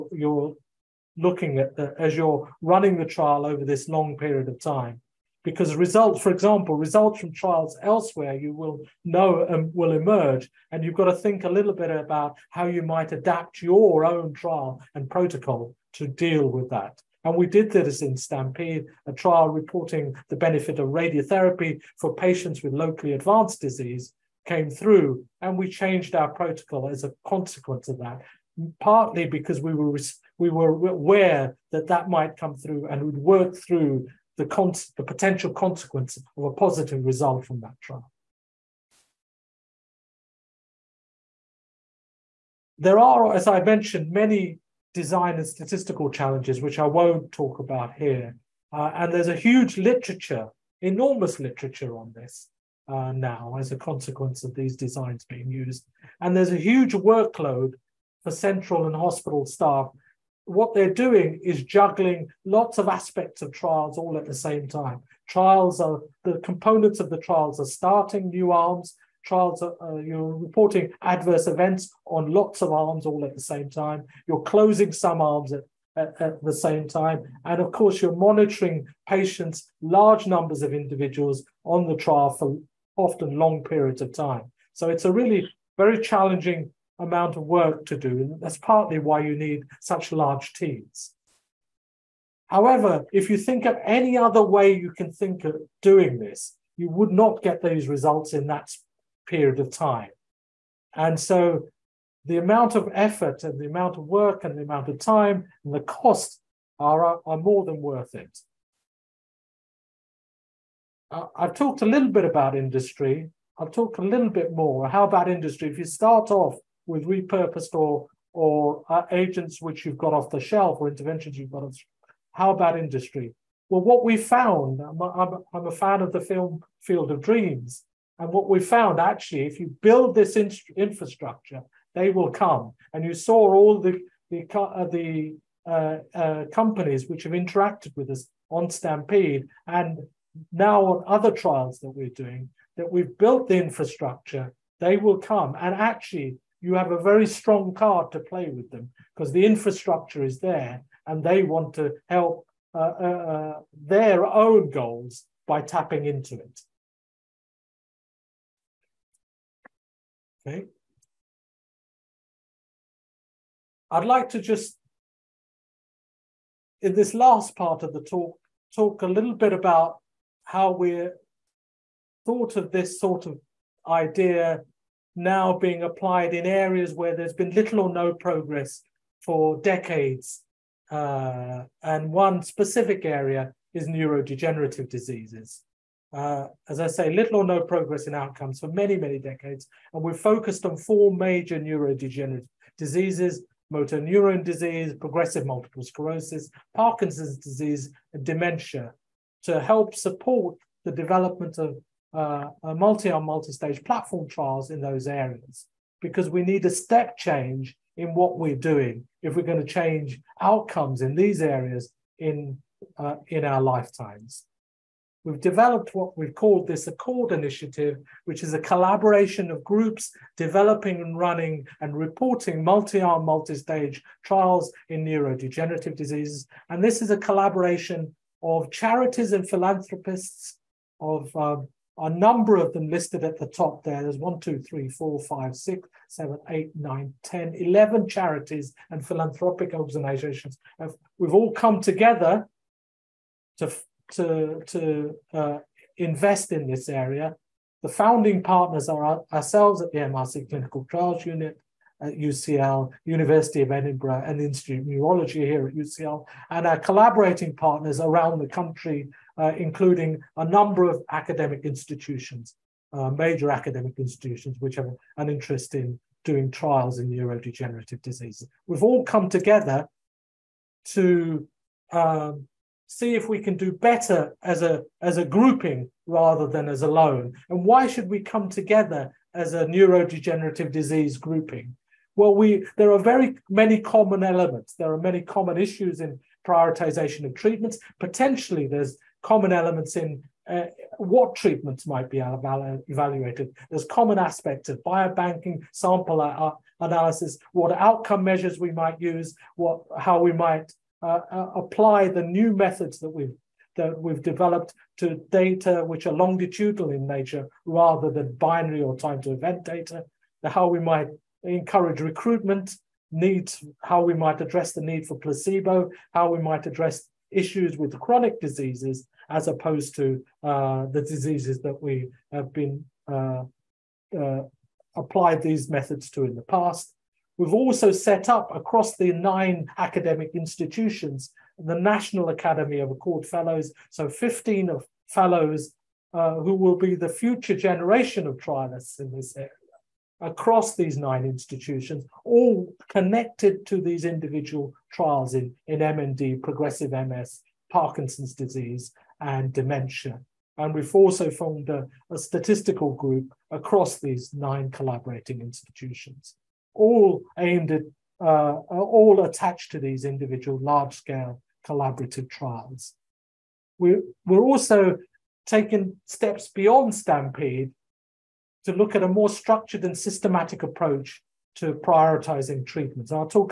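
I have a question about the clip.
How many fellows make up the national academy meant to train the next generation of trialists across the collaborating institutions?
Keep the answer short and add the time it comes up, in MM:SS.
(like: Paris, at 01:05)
15, at 05:34.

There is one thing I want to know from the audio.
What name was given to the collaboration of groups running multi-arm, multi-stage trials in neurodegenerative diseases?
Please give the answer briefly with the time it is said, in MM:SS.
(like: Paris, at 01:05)
Accord Initiative, at 03:36.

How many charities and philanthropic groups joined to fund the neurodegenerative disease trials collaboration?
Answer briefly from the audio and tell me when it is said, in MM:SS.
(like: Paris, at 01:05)
11, at 03:57.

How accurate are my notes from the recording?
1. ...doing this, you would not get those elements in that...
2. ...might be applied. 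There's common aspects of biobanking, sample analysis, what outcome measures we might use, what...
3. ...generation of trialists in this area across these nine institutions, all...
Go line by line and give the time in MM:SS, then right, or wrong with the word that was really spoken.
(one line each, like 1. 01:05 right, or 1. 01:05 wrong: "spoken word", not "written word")
1. 01:35 wrong: "results", not "elements"
2. 04:51 wrong: "evaluated", not "applied"
3. 05:37 right.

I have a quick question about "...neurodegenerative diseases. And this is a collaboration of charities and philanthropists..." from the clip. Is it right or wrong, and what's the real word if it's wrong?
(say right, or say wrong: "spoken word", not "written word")
right.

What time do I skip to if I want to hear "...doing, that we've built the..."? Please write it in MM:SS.
02:22.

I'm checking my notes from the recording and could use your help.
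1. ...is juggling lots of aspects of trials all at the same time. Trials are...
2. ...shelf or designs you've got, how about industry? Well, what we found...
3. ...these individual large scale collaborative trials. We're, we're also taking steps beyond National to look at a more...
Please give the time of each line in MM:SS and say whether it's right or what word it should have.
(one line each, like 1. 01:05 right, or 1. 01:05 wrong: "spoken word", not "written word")
1. 01:01 right
2. 02:00 wrong: "interventions", not "designs"
3. 05:59 wrong: "Stampede", not "National".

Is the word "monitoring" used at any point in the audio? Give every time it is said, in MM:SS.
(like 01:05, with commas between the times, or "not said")
01:18.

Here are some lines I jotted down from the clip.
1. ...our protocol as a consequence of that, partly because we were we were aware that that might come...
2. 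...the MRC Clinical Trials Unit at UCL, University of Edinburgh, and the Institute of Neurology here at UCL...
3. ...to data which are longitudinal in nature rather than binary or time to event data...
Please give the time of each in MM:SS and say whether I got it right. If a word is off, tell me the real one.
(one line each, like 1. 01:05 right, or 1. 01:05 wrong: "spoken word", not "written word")
1. 00:26 right
2. 04:09 right
3. 05:04 right.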